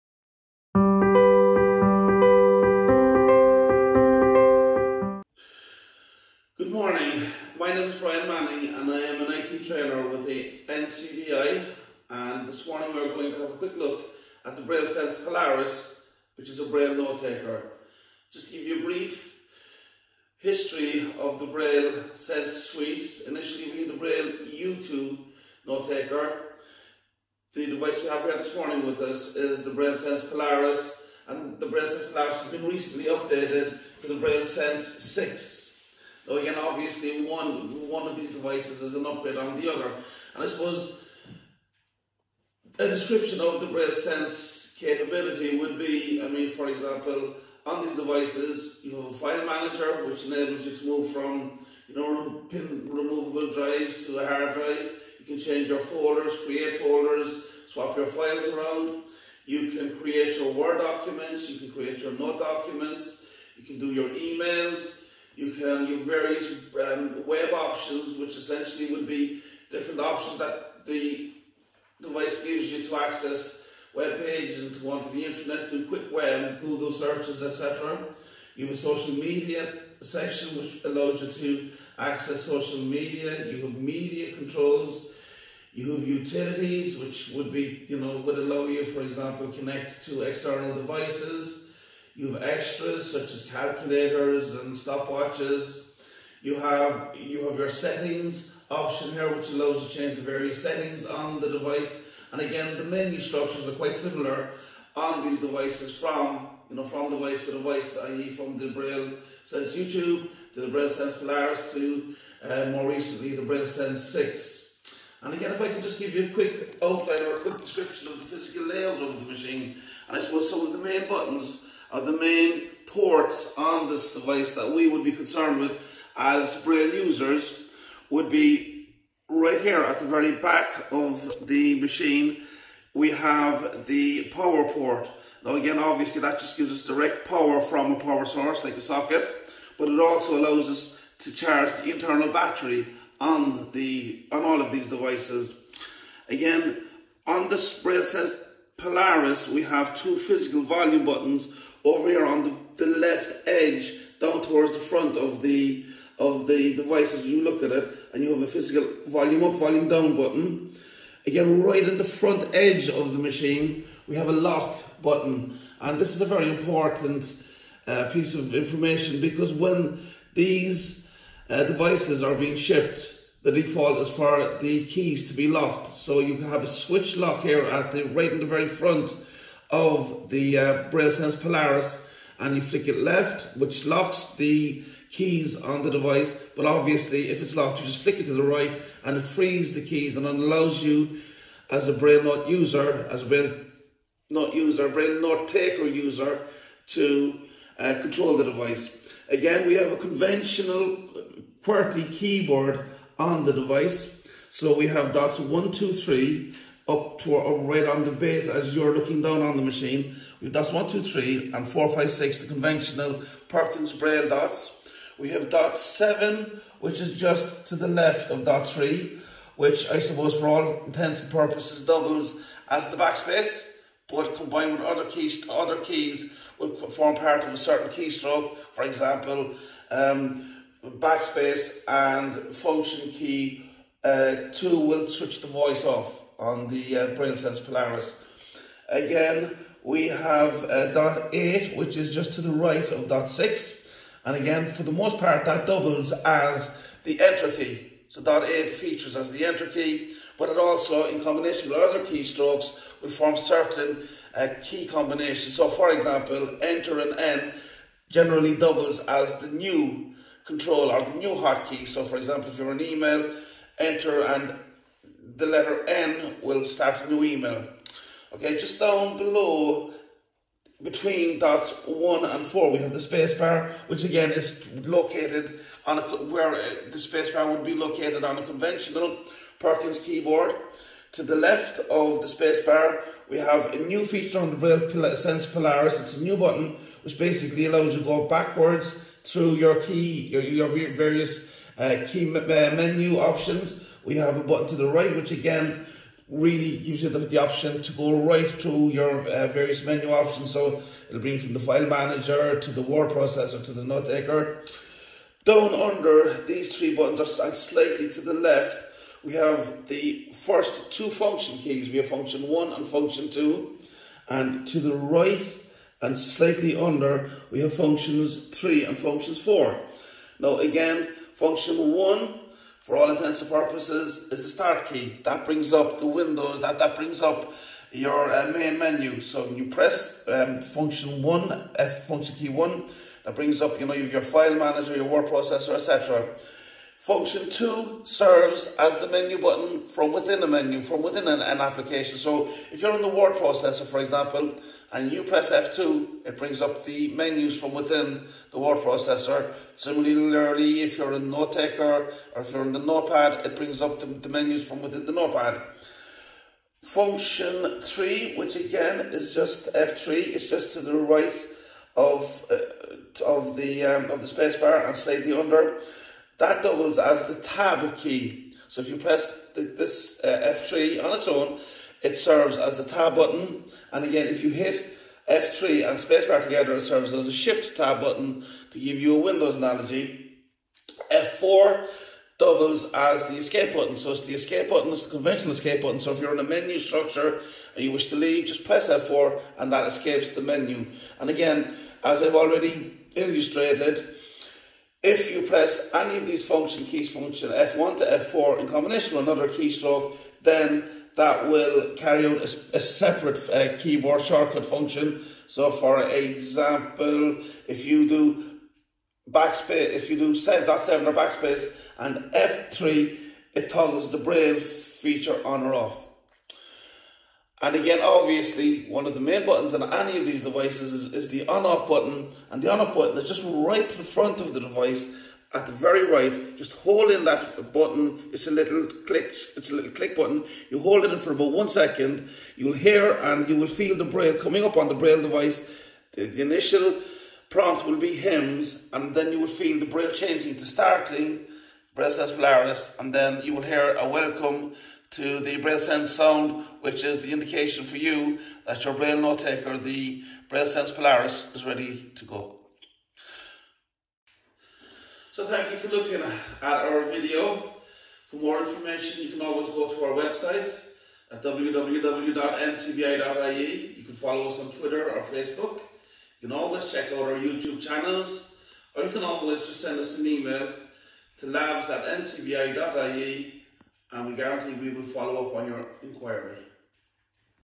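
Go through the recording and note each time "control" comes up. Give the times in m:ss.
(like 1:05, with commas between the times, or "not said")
1:24, 3:18, 4:20.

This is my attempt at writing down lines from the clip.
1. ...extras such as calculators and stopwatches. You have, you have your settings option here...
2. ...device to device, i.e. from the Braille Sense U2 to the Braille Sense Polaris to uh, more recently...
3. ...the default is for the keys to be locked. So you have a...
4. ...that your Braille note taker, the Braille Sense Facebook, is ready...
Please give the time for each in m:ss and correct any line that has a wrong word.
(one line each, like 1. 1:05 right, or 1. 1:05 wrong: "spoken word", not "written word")
1. 1:32 right
2. 1:47 right
3. 2:53 right
4. 7:28 wrong: "Polaris", not "Facebook".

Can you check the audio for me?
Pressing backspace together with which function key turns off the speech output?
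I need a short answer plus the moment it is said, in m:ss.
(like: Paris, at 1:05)
Function key 2, at 3:52.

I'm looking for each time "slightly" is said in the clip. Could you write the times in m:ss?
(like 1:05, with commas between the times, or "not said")
5:07, 5:16, 6:04.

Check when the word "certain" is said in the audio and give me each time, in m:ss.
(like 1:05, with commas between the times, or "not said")
3:47, 4:13.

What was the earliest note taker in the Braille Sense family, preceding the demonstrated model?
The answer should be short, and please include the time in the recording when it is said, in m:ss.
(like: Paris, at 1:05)
Braille U2, at 0:23.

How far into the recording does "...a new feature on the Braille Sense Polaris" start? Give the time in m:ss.
4:43.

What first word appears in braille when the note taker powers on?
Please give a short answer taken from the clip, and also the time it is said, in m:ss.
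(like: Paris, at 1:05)
HIMS, at 7:18.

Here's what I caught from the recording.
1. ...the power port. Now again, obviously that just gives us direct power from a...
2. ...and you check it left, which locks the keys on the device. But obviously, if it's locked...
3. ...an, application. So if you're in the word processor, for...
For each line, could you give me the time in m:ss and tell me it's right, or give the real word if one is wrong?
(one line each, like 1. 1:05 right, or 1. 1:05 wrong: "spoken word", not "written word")
1. 2:13 right
2. 3:02 wrong: "flick", not "check"
3. 5:41 right.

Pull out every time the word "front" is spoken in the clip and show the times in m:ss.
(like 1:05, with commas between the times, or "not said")
2:34, 2:42, 2:58, 7:04.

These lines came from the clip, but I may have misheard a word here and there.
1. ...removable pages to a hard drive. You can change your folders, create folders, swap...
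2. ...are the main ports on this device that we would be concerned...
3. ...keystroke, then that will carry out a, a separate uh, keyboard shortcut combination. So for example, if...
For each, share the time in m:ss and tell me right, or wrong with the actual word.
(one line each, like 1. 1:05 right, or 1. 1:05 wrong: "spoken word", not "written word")
1. 0:52 wrong: "drives", not "pages"
2. 2:01 right
3. 6:39 wrong: "function", not "combination".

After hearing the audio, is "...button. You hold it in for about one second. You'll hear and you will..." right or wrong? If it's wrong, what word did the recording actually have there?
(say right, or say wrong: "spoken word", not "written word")
right.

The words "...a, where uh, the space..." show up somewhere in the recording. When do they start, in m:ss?
4:35.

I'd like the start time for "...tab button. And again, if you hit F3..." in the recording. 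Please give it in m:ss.
6:12.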